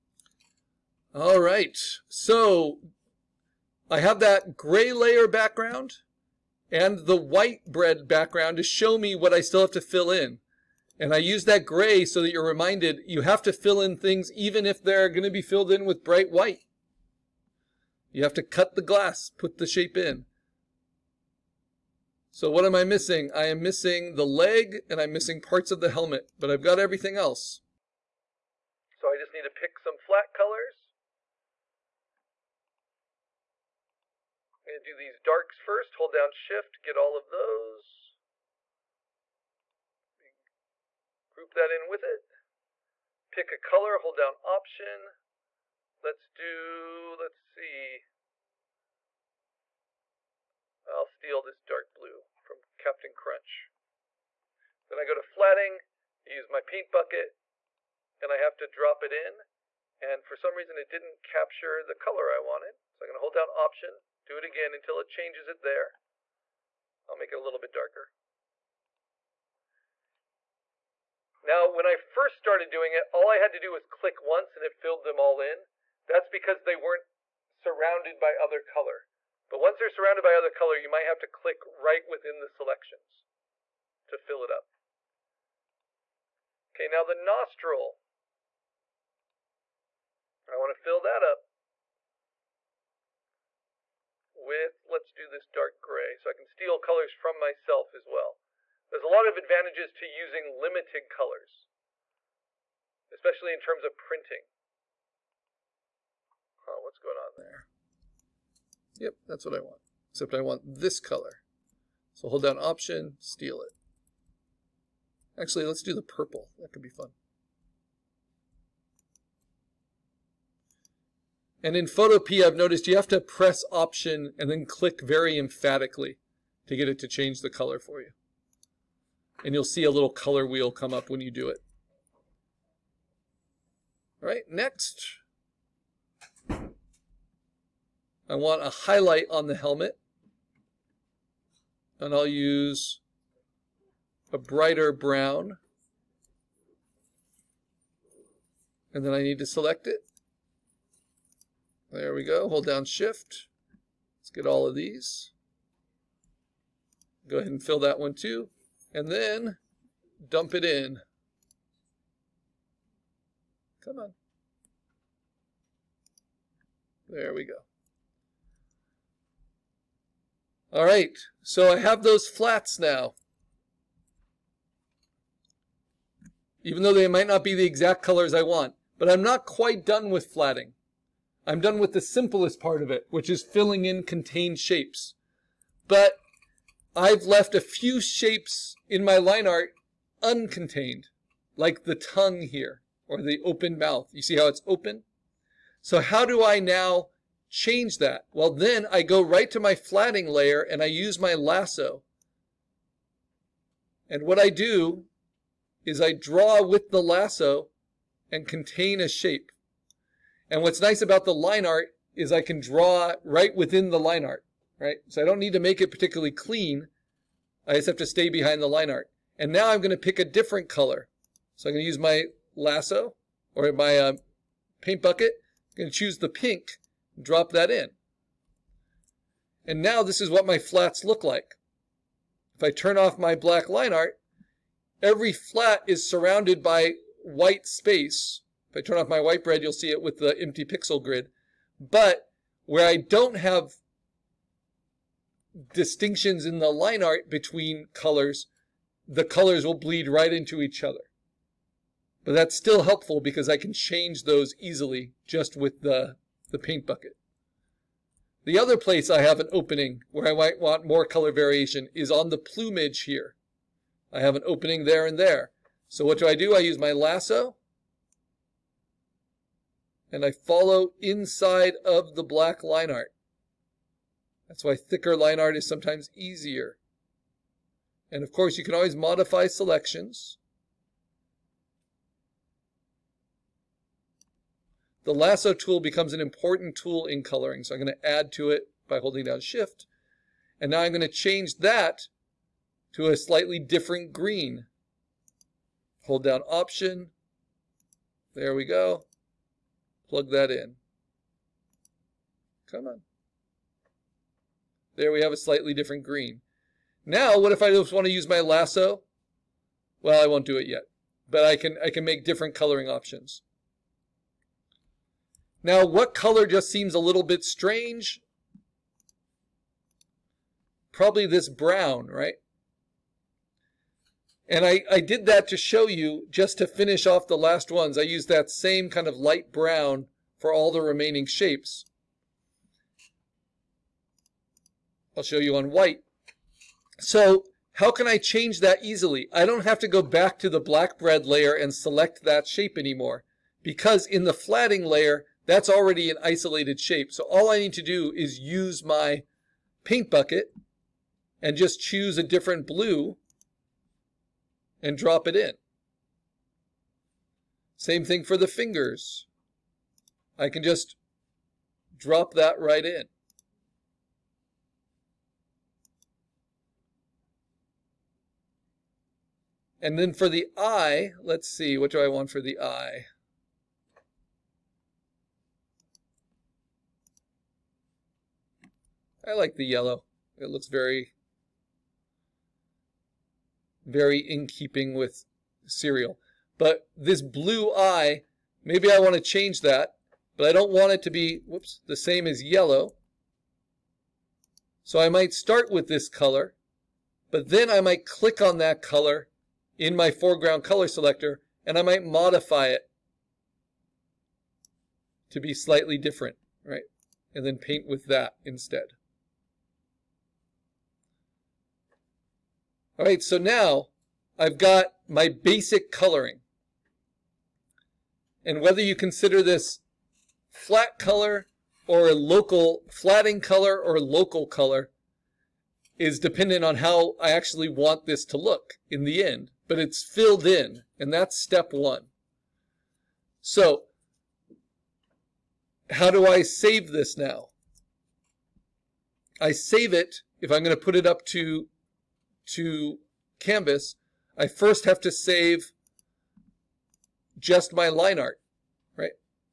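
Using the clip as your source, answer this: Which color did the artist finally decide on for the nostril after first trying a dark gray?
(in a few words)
purple.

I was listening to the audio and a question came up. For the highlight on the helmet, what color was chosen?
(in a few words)
a brighter brown.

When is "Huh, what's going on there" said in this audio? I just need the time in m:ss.
1:46.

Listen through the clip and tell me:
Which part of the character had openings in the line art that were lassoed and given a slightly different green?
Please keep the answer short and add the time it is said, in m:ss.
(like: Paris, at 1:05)
the plumage, at 4:22.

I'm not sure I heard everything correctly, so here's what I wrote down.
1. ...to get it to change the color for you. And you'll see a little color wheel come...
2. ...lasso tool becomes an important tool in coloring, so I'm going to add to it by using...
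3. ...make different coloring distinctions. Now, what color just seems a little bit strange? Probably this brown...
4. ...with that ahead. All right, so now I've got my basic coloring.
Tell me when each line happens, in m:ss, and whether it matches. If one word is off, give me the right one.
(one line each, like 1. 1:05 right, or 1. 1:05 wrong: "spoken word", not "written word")
1. 2:06 right
2. 4:45 wrong: "holding", not "using"
3. 5:12 wrong: "options", not "distinctions"
4. 6:47 wrong: "instead", not "ahead".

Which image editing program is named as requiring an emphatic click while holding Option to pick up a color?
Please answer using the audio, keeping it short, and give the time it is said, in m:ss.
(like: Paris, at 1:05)
Photopea, at 2:01.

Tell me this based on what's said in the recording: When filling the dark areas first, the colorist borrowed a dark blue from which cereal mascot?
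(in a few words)
Captain Crunch.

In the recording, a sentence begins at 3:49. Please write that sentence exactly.
And now this is what my flats look like.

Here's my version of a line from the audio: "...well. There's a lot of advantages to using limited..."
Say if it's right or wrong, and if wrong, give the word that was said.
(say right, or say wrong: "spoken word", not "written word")
right.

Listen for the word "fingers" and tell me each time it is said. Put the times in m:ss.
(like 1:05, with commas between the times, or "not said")
5:58.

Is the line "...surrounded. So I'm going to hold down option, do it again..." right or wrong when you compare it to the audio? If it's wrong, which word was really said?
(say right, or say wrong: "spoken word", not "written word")
wrong: "wanted", not "surrounded".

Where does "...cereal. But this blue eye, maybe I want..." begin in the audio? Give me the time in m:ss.
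6:25.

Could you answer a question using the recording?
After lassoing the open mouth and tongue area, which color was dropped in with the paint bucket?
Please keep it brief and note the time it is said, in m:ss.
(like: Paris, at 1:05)
pink, at 3:46.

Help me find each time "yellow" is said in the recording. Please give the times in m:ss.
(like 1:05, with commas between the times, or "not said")
6:19, 6:32.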